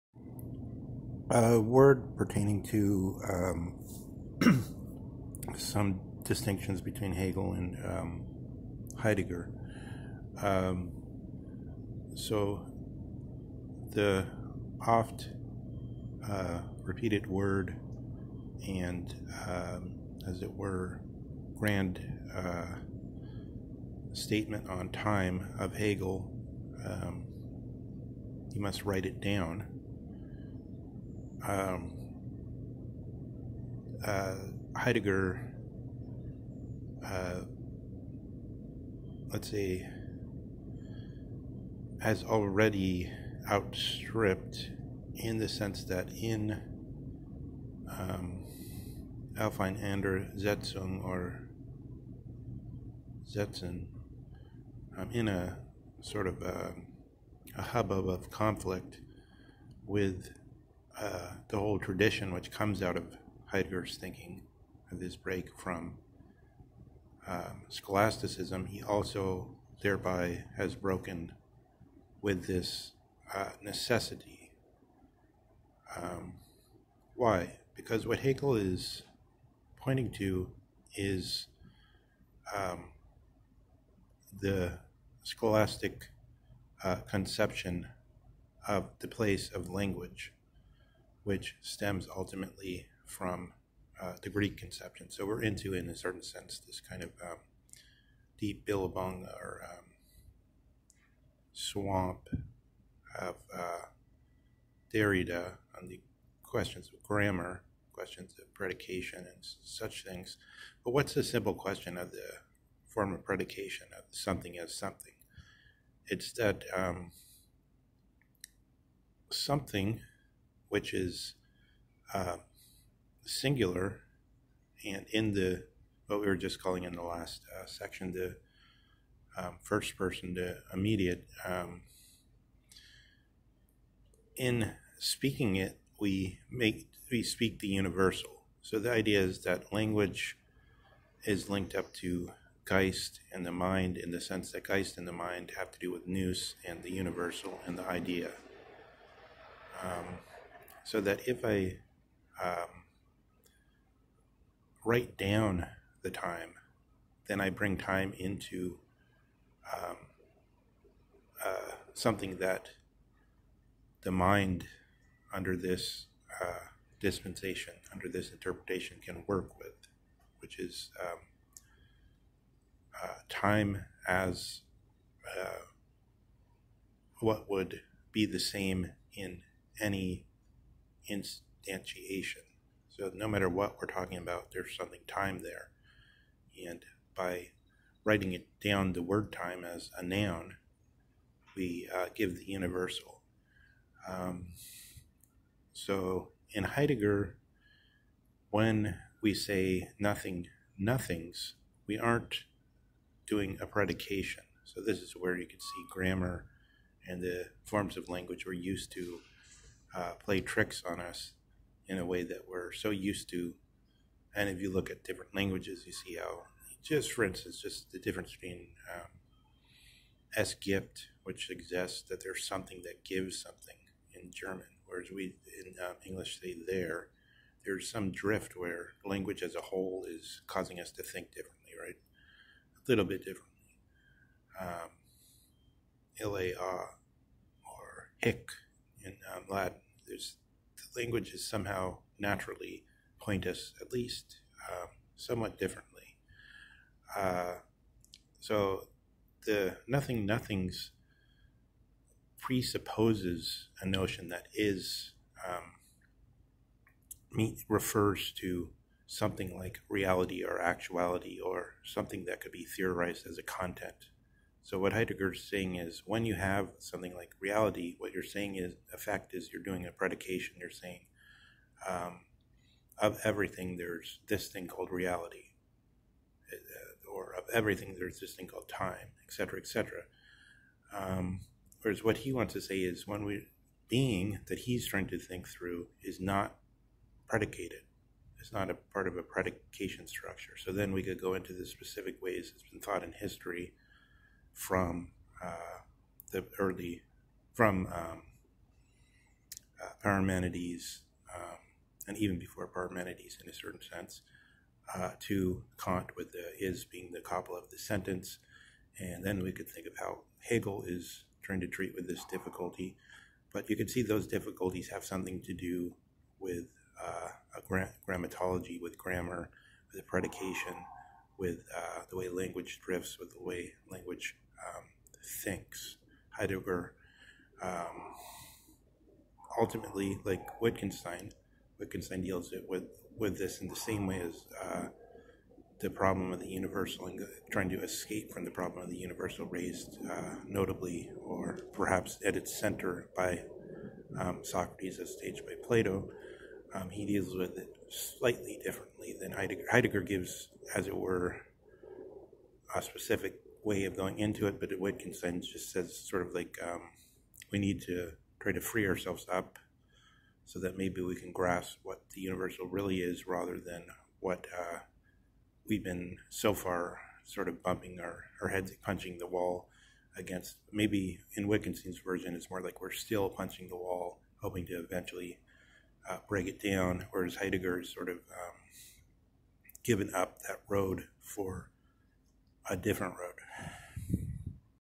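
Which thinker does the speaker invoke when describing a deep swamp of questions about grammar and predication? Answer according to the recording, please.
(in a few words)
Derrida.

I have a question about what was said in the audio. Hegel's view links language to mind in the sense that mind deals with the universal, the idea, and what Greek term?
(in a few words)
nous.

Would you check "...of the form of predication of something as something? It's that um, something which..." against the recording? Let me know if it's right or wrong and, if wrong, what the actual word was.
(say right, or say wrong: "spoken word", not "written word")
right.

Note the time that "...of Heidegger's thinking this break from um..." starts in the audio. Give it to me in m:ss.
1:02.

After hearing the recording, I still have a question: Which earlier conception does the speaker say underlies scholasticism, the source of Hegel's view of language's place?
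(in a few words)
The Greek conception.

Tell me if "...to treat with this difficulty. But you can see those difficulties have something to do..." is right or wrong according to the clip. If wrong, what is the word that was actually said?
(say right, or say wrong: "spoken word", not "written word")
right.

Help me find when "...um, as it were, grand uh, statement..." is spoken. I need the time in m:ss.
0:19.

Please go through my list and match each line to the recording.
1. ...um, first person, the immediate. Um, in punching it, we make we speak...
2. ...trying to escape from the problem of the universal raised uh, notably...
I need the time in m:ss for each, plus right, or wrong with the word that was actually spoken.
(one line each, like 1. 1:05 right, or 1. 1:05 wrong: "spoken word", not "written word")
1. 2:09 wrong: "speaking", not "punching"
2. 5:37 right.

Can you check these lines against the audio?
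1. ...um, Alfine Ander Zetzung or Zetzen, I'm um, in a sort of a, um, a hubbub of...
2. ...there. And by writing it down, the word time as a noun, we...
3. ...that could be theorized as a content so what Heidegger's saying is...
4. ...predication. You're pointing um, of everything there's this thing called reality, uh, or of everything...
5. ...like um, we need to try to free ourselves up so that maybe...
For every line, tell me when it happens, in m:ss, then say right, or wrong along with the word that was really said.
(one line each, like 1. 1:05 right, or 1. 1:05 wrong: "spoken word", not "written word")
1. 0:47 right
2. 3:05 right
3. 4:22 right
4. 4:29 wrong: "saying", not "pointing"
5. 5:56 right.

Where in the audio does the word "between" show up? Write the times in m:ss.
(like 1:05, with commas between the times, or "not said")
0:06, 3:38.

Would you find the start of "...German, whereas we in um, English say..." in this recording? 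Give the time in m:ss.
3:44.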